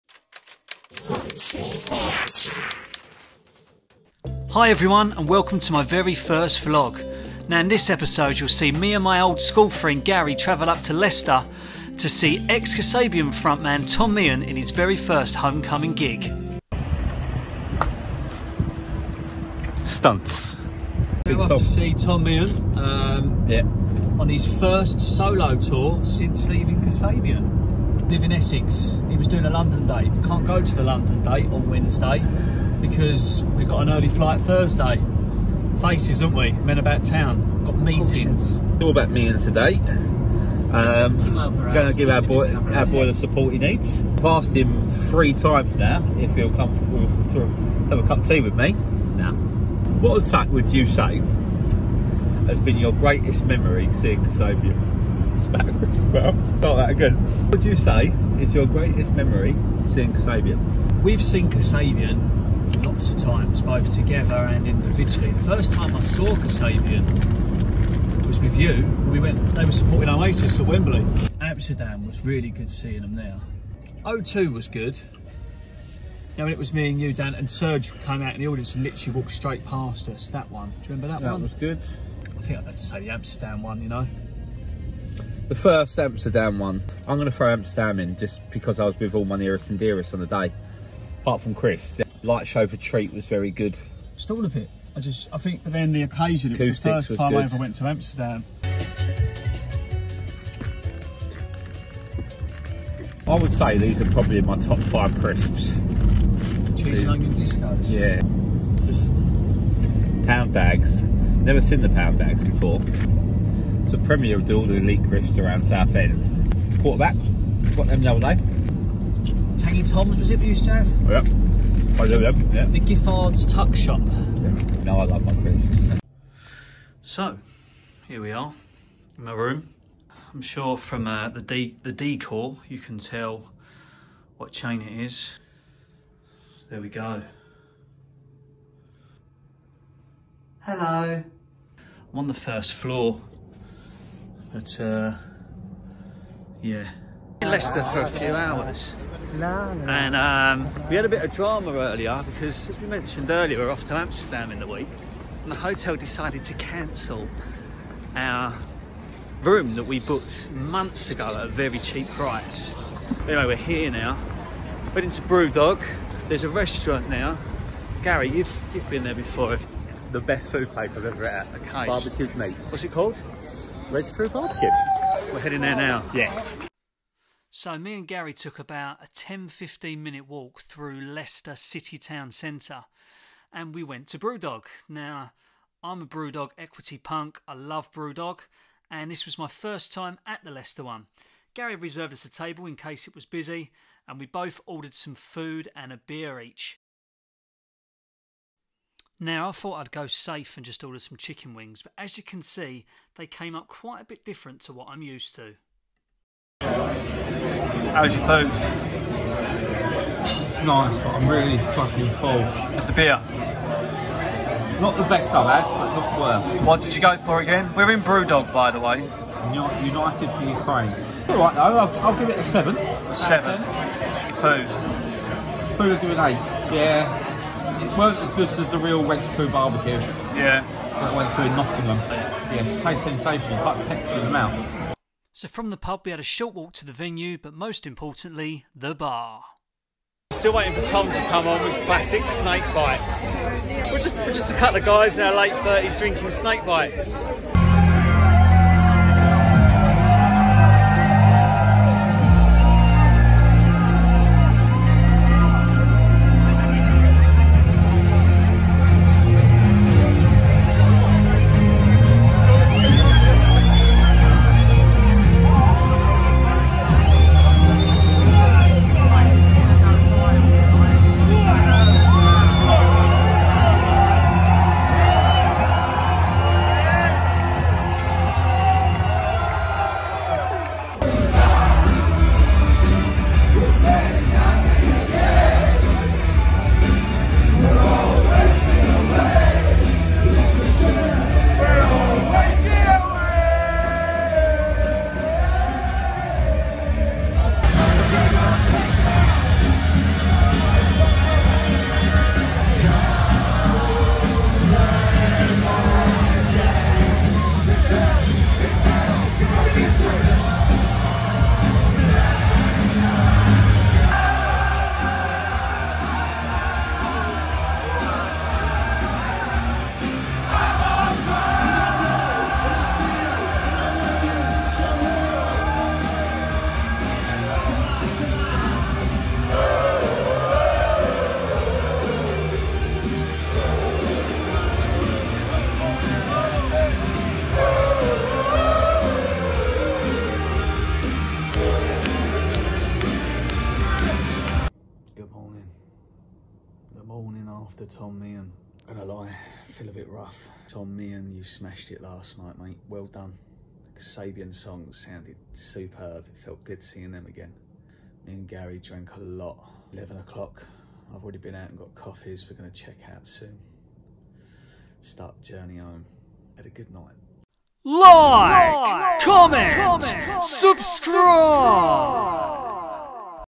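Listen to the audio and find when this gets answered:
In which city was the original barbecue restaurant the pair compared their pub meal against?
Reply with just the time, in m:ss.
3:51.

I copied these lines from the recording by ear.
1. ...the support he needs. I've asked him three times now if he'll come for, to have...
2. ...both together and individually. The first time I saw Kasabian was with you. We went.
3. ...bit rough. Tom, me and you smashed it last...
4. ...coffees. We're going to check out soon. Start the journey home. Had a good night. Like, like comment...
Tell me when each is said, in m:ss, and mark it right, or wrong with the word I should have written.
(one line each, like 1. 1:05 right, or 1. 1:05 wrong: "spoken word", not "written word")
1. 0:43 right
2. 1:03 right
3. 5:49 right
4. 6:01 right.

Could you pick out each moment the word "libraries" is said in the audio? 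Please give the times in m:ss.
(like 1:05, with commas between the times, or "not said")
not said.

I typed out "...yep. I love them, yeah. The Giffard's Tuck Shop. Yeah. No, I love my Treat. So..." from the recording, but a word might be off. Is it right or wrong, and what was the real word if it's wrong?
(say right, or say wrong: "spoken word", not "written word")
wrong: "Christmas", not "Treat".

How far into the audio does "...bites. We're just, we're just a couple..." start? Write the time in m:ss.
4:02.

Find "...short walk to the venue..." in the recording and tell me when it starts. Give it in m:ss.
3:56.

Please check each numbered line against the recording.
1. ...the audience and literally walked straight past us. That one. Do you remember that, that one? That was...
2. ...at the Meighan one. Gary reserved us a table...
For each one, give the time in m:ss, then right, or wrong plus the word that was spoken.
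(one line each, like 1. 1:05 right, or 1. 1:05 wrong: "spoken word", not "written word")
1. 1:18 right
2. 3:10 wrong: "Leicester", not "Meighan".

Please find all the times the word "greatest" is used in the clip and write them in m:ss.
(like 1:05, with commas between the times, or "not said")
0:52, 0:58.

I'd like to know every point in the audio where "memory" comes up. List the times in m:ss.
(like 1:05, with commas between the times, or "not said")
0:53, 0:59.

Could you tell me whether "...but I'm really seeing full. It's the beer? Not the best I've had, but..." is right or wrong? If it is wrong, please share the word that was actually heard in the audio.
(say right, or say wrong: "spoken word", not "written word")
wrong: "fucking", not "seeing".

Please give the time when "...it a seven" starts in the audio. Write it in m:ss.
3:42.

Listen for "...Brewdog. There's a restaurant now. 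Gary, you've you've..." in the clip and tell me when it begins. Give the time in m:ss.
2:45.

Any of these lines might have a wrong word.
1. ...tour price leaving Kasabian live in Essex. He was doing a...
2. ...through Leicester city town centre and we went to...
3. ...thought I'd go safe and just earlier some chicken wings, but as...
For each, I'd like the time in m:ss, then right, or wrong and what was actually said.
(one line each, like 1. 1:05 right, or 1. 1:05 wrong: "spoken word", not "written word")
1. 0:25 wrong: "since", not "price"
2. 3:00 right
3. 3:19 wrong: "order", not "earlier".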